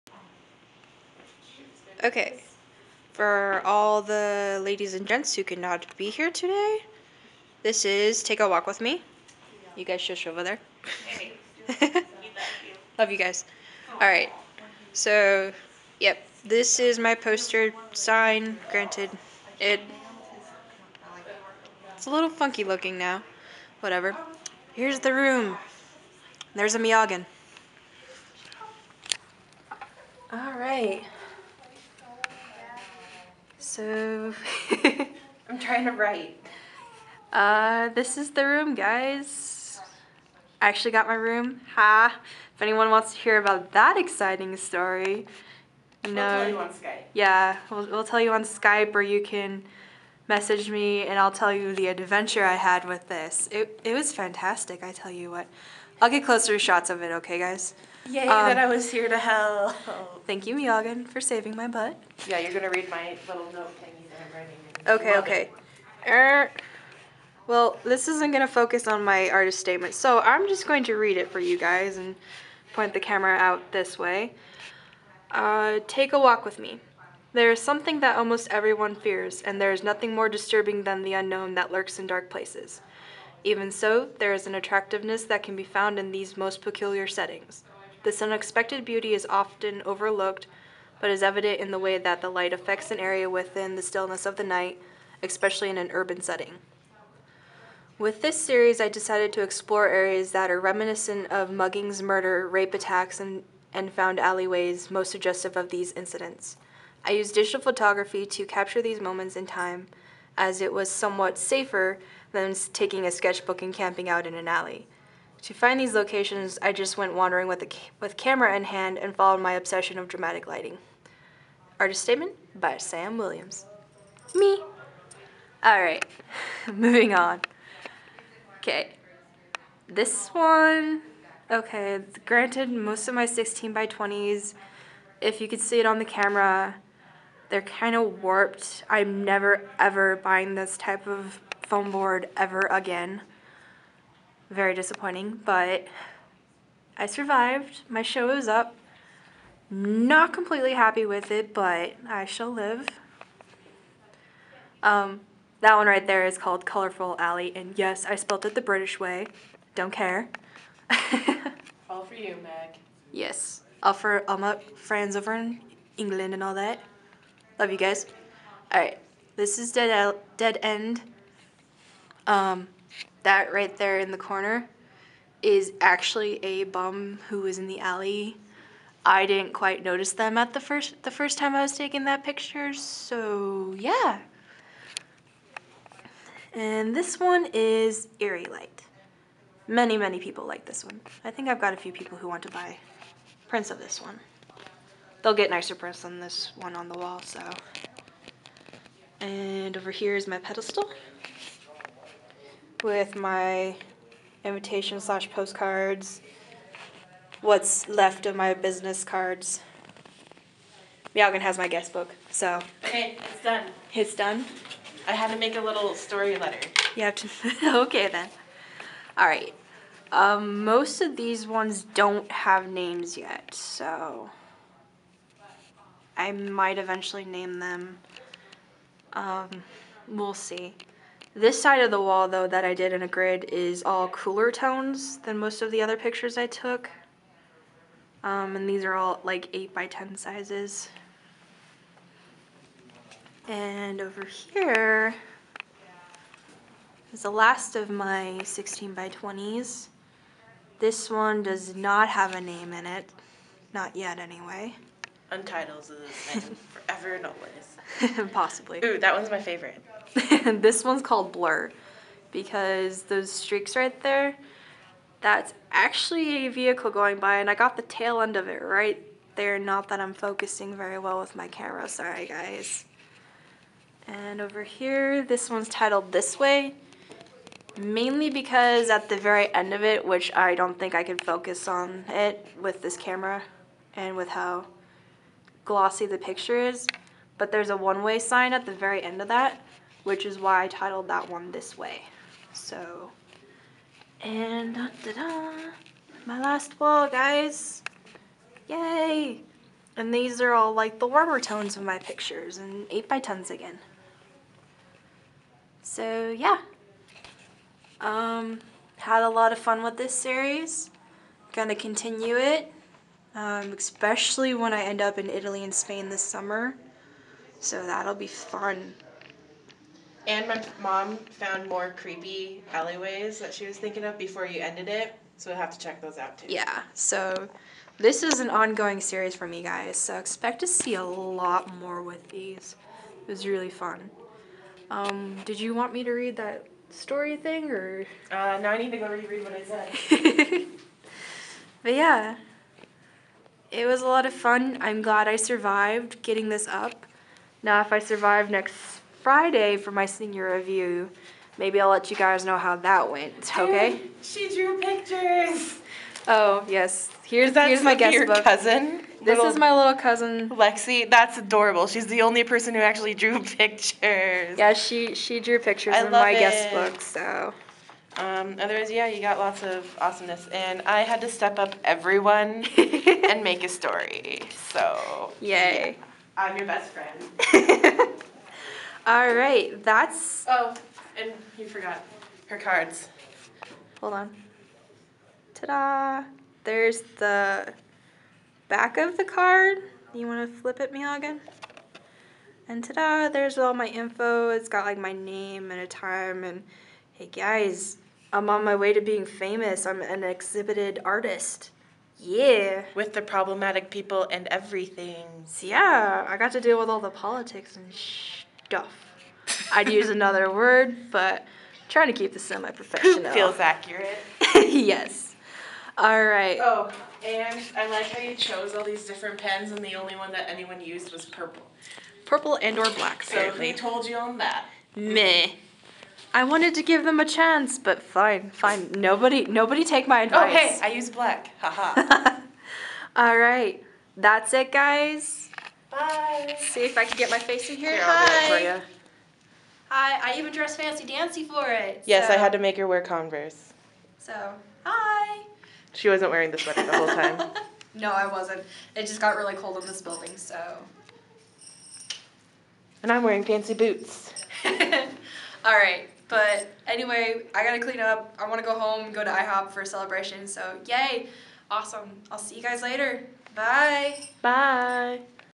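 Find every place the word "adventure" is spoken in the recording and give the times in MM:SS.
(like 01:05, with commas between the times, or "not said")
00:51.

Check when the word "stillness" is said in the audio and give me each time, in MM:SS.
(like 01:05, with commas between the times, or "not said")
01:33.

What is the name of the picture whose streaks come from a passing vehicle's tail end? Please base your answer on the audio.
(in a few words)
Blur.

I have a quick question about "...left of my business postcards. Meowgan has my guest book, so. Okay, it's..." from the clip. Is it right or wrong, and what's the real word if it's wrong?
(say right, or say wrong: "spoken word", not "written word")
wrong: "cards", not "postcards".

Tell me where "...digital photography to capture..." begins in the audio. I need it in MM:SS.
01:47.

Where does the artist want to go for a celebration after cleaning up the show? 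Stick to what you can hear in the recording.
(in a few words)
IHOP.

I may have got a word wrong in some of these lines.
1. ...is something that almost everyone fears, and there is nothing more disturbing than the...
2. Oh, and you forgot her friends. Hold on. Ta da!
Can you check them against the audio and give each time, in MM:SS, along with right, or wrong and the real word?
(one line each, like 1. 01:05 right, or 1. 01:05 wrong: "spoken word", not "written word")
1. 01:17 right
2. 06:20 wrong: "cards", not "friends".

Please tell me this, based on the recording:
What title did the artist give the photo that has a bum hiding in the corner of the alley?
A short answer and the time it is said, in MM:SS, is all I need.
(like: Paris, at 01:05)
Dead End, at 02:50.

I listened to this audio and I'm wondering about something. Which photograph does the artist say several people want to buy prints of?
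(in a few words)
Eerie Light.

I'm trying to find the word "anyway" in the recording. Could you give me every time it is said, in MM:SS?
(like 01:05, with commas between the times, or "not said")
04:14, 07:36.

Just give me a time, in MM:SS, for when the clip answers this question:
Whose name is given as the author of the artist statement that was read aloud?
02:02.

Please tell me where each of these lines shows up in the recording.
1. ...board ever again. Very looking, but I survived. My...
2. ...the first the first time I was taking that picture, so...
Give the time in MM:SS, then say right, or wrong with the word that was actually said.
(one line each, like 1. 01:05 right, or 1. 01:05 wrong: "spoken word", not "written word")
1. 02:21 wrong: "disappointing", not "looking"
2. 03:00 right.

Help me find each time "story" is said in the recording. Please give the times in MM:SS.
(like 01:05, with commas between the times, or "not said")
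00:44, 03:35, 05:36, 06:13.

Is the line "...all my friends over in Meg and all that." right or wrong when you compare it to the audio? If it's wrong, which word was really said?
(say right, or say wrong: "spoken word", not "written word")
wrong: "England", not "Meg".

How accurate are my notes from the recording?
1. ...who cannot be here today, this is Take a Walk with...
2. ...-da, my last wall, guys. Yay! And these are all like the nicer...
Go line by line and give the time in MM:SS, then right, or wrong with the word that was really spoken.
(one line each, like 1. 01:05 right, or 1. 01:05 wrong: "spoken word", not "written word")
1. 00:05 right
2. 04:55 wrong: "warmer", not "nicer".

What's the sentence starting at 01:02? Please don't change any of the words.
Yeah, you're going to read my little note thingy that I'm writing.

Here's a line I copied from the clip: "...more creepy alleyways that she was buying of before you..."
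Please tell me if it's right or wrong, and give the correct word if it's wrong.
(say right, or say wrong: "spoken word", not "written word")
wrong: "thinking", not "buying".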